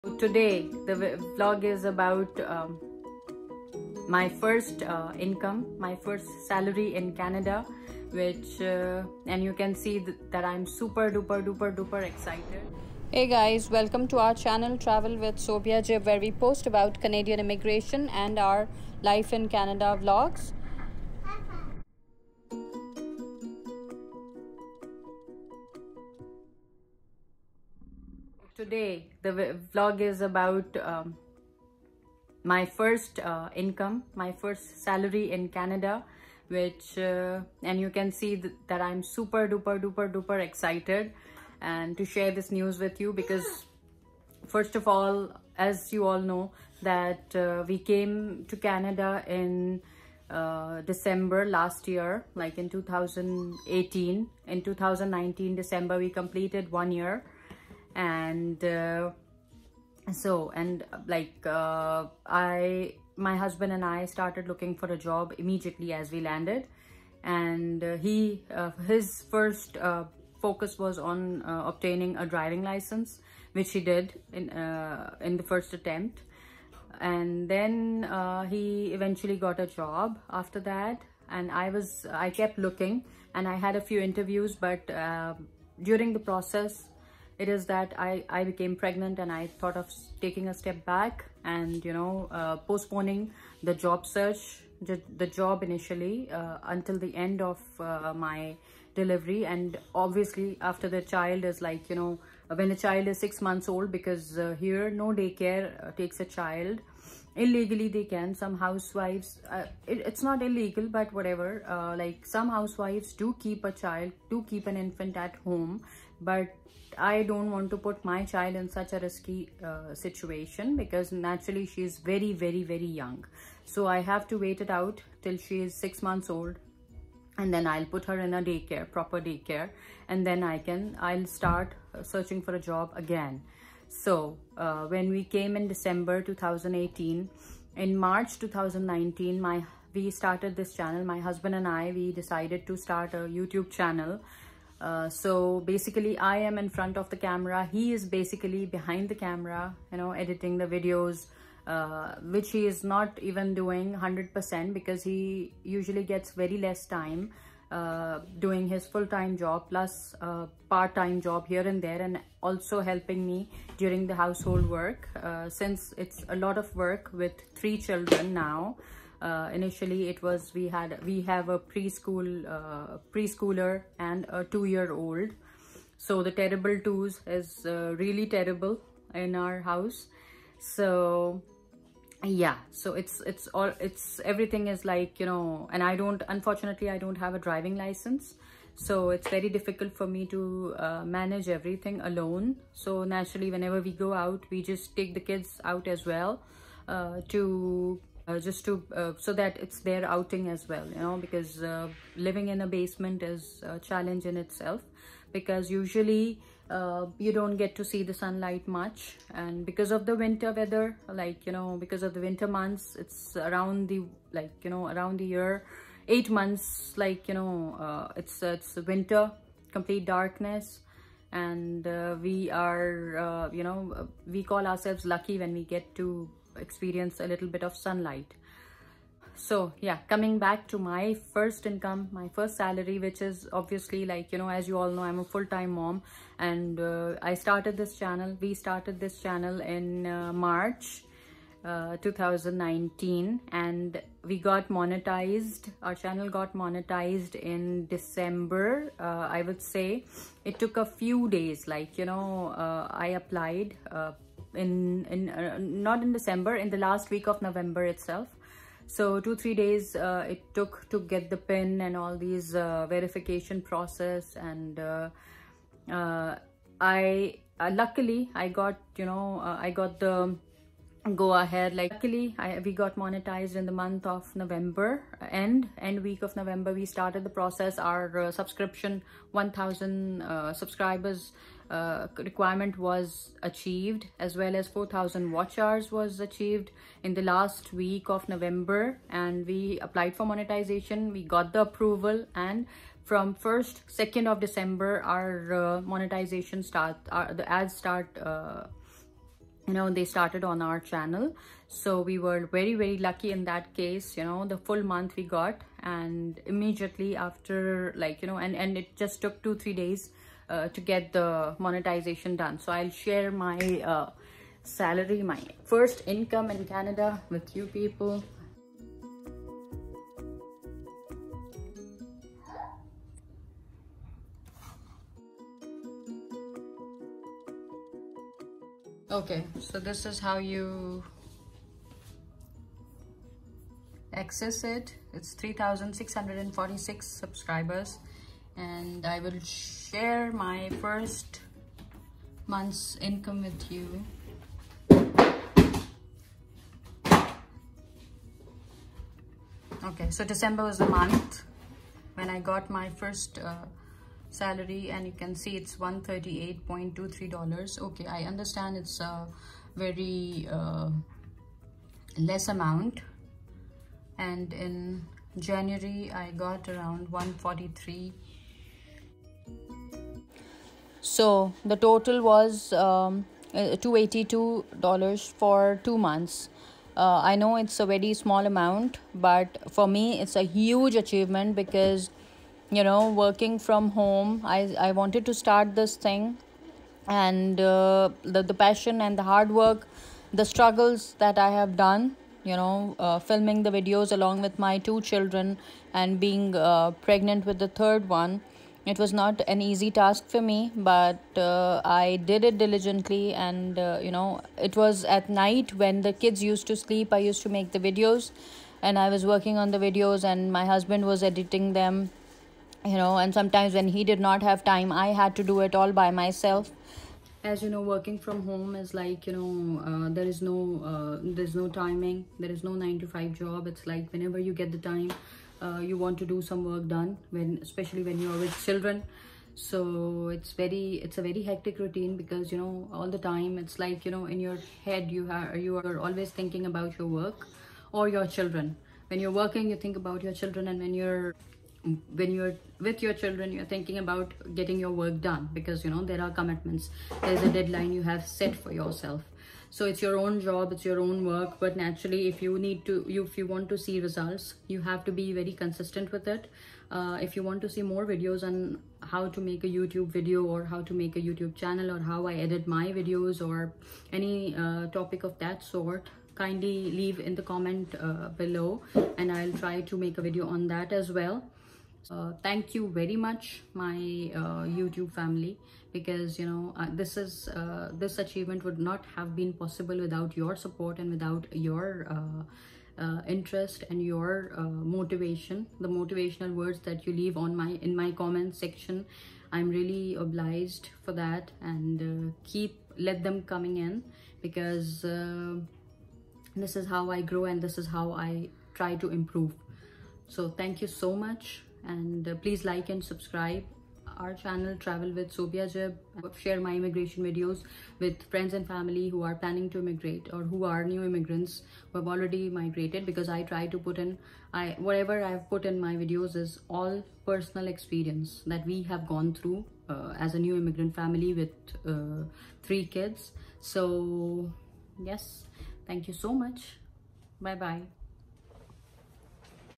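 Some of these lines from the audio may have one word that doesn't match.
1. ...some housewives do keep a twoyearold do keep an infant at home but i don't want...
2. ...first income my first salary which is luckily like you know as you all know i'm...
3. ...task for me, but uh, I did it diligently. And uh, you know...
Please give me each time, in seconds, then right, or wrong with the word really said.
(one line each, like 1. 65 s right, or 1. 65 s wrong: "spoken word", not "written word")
1. 112 s wrong: "child", not "twoyearold"
2. 231 s wrong: "obviously", not "luckily"
3. 399 s right.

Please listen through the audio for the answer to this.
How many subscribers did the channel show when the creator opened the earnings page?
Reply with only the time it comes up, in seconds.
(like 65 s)
335 s.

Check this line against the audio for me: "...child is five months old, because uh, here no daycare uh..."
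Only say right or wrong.
wrong.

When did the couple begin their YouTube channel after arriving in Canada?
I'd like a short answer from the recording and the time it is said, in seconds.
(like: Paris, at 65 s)
March 2019, at 137 s.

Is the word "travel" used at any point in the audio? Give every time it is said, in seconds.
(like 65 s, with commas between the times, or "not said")
14 s, 504 s.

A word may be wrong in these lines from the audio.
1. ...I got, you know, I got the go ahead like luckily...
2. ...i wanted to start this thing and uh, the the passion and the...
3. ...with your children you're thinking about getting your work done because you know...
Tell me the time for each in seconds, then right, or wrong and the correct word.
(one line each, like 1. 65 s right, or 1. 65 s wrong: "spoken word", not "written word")
1. 268 s right
2. 384 s right
3. 442 s right.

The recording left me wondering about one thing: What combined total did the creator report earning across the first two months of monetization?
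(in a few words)
$282.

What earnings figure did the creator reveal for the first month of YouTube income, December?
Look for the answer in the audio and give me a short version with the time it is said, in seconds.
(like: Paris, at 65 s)
$138.23, at 355 s.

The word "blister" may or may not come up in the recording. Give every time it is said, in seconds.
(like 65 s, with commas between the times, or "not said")
not said.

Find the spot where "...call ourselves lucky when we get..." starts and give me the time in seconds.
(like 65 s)
224 s.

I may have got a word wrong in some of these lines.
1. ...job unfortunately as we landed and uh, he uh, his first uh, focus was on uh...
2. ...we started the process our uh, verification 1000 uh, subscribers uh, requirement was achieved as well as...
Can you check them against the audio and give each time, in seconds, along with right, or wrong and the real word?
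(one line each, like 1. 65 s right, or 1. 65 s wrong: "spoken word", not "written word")
1. 64 s wrong: "immediately", not "unfortunately"
2. 276 s wrong: "subscription", not "verification".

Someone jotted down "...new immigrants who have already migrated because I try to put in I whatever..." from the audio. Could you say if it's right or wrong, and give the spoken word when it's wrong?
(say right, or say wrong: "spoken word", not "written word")
right.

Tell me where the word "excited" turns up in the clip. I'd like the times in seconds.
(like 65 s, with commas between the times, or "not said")
12 s, 40 s.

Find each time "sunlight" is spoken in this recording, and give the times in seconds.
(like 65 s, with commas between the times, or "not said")
208 s, 227 s.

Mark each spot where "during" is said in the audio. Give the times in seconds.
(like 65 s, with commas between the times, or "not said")
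85 s, 163 s.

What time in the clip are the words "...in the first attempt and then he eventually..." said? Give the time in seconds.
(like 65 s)
75 s.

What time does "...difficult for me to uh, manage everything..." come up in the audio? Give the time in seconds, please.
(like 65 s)
189 s.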